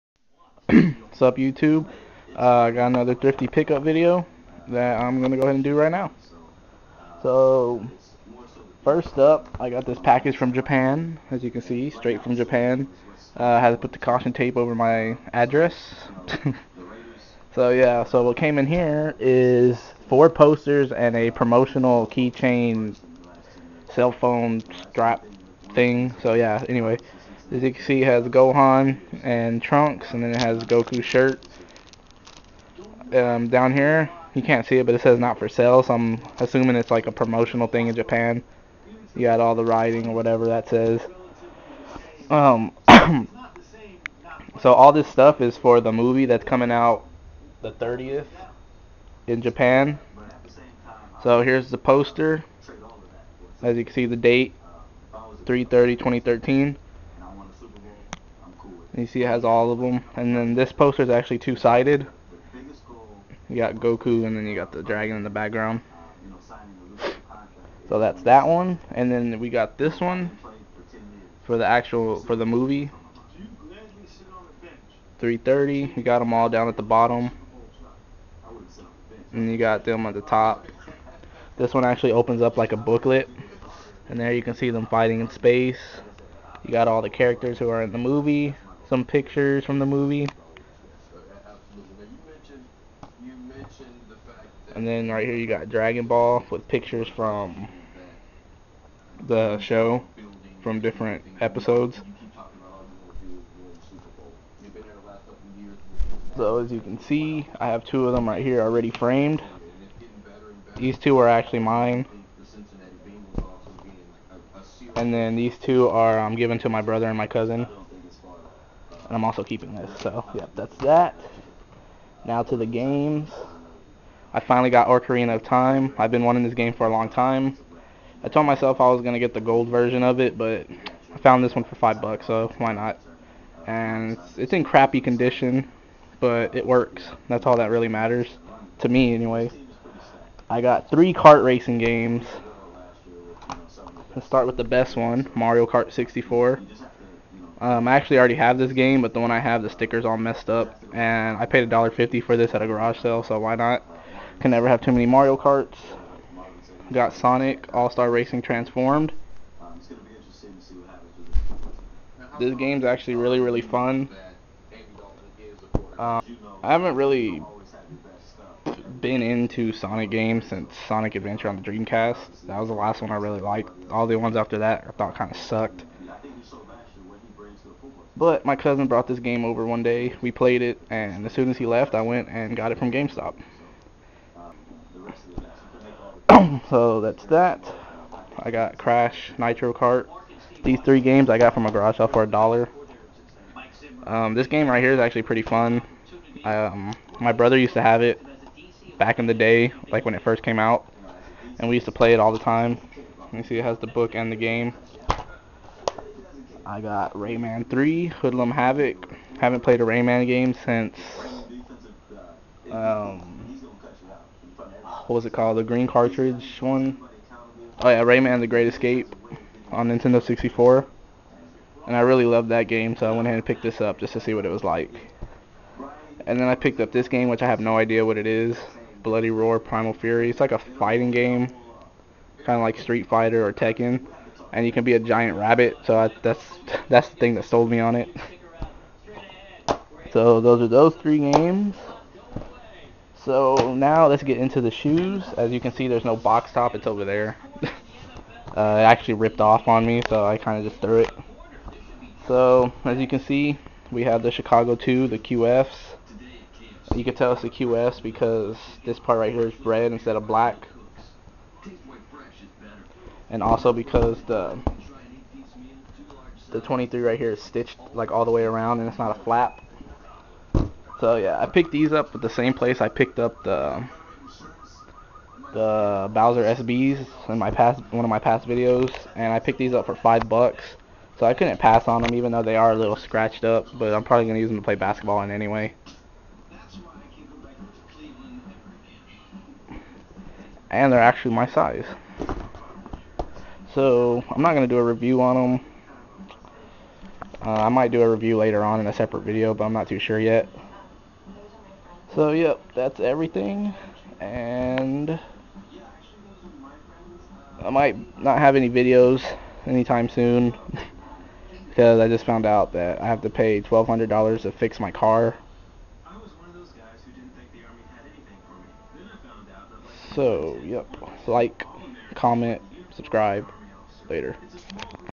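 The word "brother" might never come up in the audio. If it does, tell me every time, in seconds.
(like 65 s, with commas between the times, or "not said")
116 s, 197 s.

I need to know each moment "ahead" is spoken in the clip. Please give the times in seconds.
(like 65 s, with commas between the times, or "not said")
5 s, 223 s.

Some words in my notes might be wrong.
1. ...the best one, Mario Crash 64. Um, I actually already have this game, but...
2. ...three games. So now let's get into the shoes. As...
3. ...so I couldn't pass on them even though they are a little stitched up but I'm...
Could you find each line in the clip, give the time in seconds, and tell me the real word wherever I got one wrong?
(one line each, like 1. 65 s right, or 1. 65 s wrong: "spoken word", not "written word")
1. 144 s wrong: "Kart", not "Crash"
2. 240 s right
3. 281 s wrong: "scratched", not "stitched".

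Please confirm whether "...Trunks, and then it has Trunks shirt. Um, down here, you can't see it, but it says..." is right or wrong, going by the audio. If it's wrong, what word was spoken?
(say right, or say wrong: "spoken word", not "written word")
wrong: "Goku", not "Trunks".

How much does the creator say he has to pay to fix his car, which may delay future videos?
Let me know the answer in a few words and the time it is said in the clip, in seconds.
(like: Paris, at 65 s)
$1,200, at 313 s.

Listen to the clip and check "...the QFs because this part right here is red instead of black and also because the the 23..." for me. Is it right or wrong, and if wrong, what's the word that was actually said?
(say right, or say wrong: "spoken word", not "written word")
right.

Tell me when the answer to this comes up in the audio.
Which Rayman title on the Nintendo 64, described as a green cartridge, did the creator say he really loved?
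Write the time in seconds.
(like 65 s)
218 s.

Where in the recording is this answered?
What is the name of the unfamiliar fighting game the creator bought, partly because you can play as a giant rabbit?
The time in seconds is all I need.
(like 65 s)
229 s.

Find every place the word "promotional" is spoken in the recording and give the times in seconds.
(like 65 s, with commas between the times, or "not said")
21 s, 37 s.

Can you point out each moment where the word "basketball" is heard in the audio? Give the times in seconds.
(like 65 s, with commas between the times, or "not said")
284 s.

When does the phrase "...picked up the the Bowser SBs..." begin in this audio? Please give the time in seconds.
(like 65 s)
272 s.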